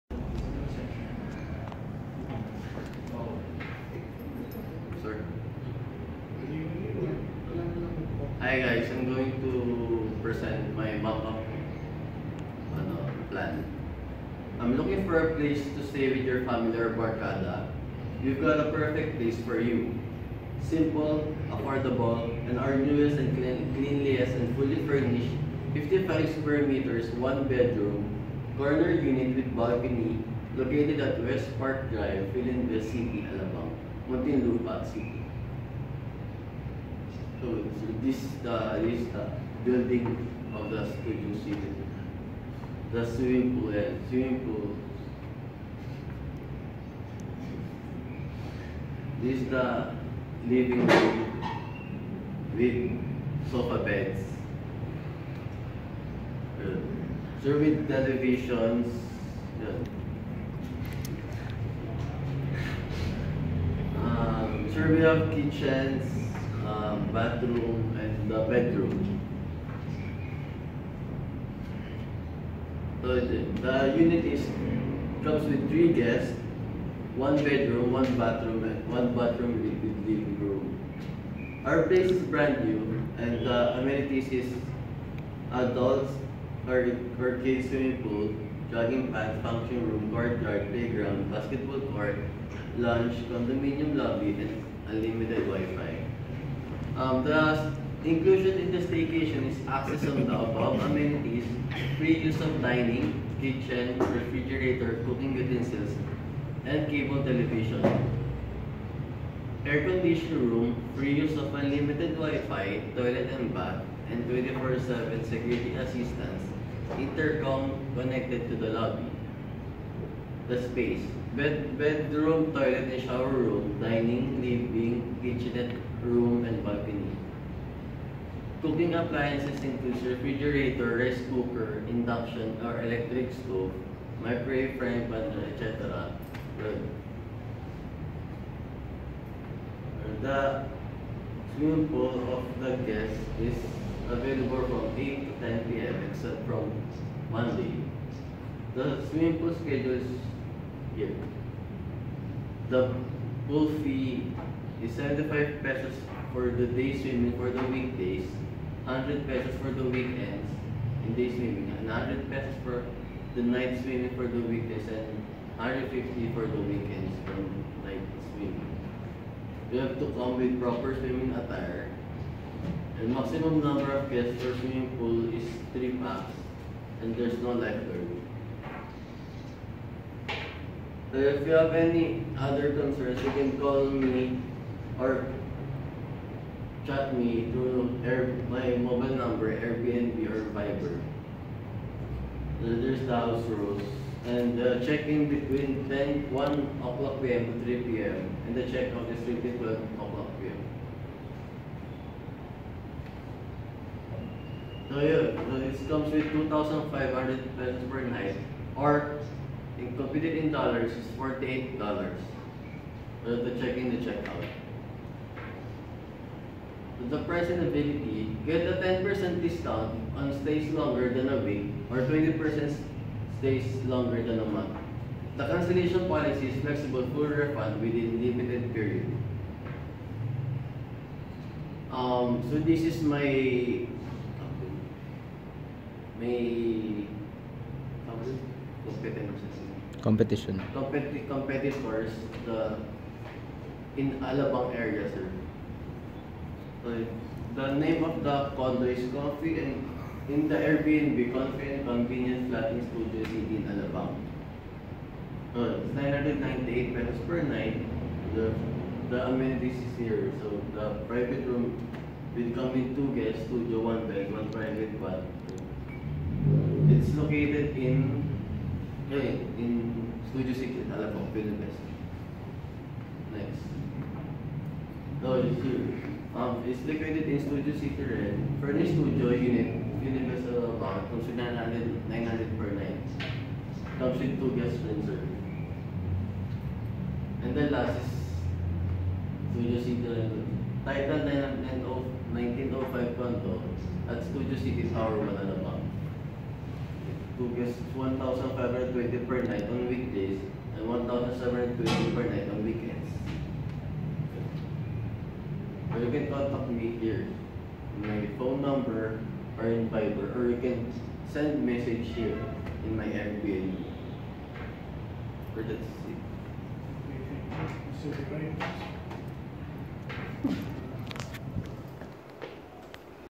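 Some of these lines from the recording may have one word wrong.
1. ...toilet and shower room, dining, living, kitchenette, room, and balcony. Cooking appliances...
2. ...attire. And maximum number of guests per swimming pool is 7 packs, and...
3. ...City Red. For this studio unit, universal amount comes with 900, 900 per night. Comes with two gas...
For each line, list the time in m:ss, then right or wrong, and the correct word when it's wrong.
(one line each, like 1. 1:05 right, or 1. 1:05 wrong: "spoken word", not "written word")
1. 2:02 right
2. 2:51 wrong: "3", not "7"
3. 4:37 right.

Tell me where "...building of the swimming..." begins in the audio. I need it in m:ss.
0:39.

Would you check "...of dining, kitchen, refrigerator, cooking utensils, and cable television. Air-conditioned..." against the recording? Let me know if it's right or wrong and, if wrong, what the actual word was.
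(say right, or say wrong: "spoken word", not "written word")
right.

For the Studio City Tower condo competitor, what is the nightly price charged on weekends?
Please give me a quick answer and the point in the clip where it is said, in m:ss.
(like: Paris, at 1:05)
1,720, at 5:00.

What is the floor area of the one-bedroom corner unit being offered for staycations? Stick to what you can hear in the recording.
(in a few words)
55 square meters.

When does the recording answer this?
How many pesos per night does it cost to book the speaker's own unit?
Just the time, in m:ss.
3:26.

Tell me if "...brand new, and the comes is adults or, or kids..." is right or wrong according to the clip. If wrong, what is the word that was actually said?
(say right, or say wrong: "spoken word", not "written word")
wrong: "amenities", not "comes".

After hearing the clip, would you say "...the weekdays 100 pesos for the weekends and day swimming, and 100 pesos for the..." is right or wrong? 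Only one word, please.
right.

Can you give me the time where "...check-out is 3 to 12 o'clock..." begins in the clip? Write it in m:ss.
3:18.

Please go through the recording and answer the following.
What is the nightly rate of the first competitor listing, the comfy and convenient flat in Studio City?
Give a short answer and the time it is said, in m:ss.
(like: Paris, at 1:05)
998 pesos, at 4:15.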